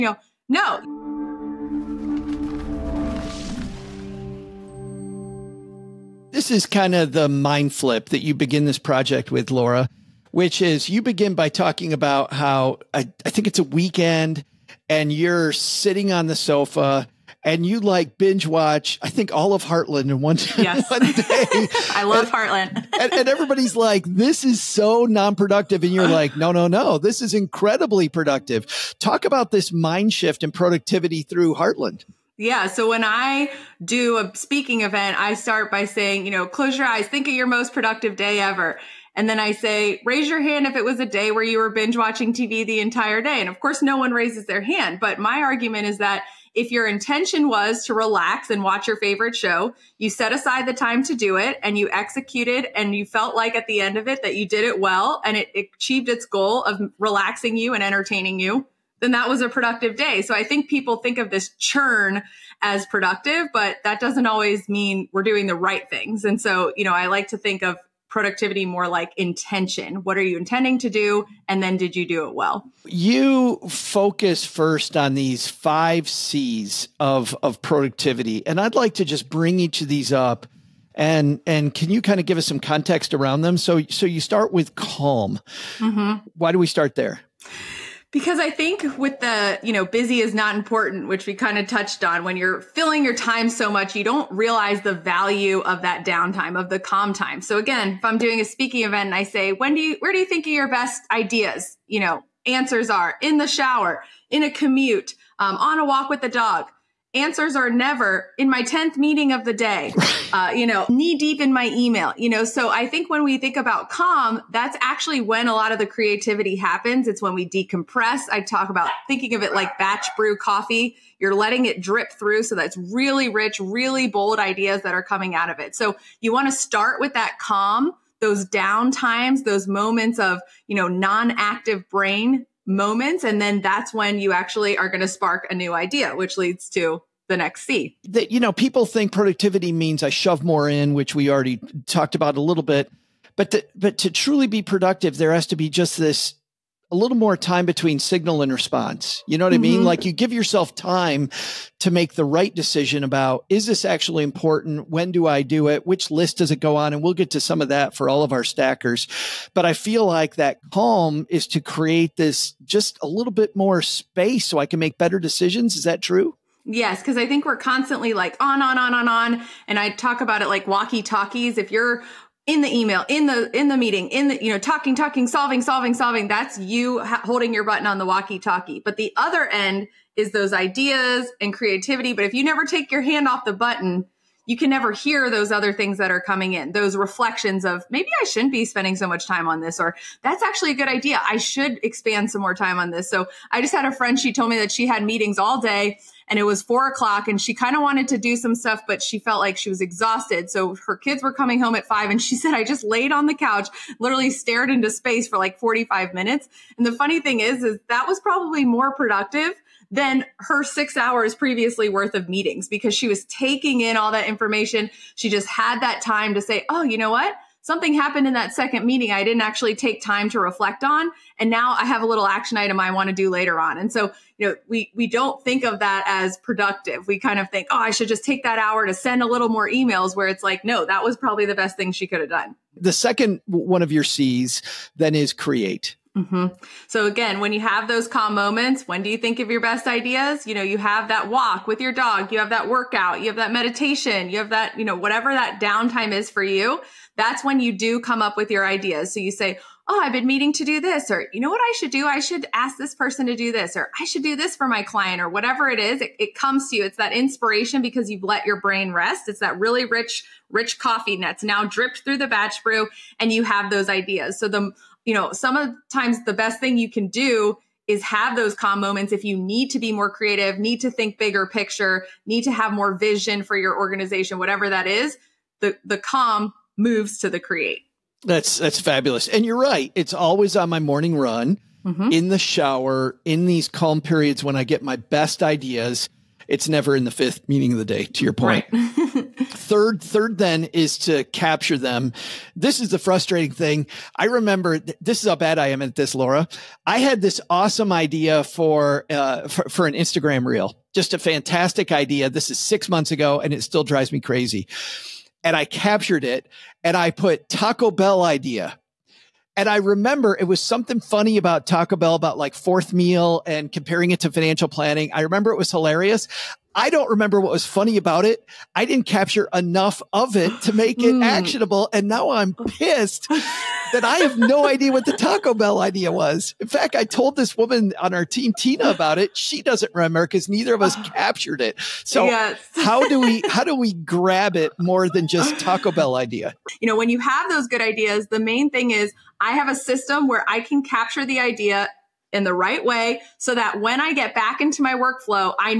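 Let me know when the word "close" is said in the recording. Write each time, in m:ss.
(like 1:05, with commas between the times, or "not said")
0:36.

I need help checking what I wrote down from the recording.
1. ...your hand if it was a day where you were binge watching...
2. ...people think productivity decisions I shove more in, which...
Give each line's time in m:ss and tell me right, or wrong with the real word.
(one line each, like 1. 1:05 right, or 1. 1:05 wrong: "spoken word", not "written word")
1. 0:40 right
2. 2:18 wrong: "means", not "decisions".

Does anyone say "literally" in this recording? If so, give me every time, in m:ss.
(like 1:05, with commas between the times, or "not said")
3:23.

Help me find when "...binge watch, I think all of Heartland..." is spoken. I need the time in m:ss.
0:18.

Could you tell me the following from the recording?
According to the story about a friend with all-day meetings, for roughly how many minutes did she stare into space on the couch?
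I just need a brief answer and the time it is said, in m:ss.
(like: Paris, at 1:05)
45, at 3:25.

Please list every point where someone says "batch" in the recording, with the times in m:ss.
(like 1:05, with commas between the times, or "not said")
1:59, 4:22.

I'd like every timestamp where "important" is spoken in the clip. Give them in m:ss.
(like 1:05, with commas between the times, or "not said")
1:30, 2:34.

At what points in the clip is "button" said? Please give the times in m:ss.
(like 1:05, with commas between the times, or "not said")
2:57, 3:03.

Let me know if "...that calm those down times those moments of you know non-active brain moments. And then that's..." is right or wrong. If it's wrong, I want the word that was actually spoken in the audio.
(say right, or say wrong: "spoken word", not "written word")
right.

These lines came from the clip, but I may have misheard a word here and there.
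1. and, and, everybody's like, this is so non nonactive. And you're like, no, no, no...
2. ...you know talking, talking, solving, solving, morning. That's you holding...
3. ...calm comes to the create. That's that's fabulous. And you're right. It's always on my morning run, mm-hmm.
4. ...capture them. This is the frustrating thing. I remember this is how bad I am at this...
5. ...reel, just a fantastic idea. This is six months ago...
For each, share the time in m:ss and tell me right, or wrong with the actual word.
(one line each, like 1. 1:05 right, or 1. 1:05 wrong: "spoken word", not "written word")
1. 0:22 wrong: "productive", not "nonactive"
2. 2:54 wrong: "solving", not "morning"
3. 4:35 wrong: "moves", not "comes"
4. 4:51 right
5. 5:00 right.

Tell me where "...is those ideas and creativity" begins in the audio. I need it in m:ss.
3:00.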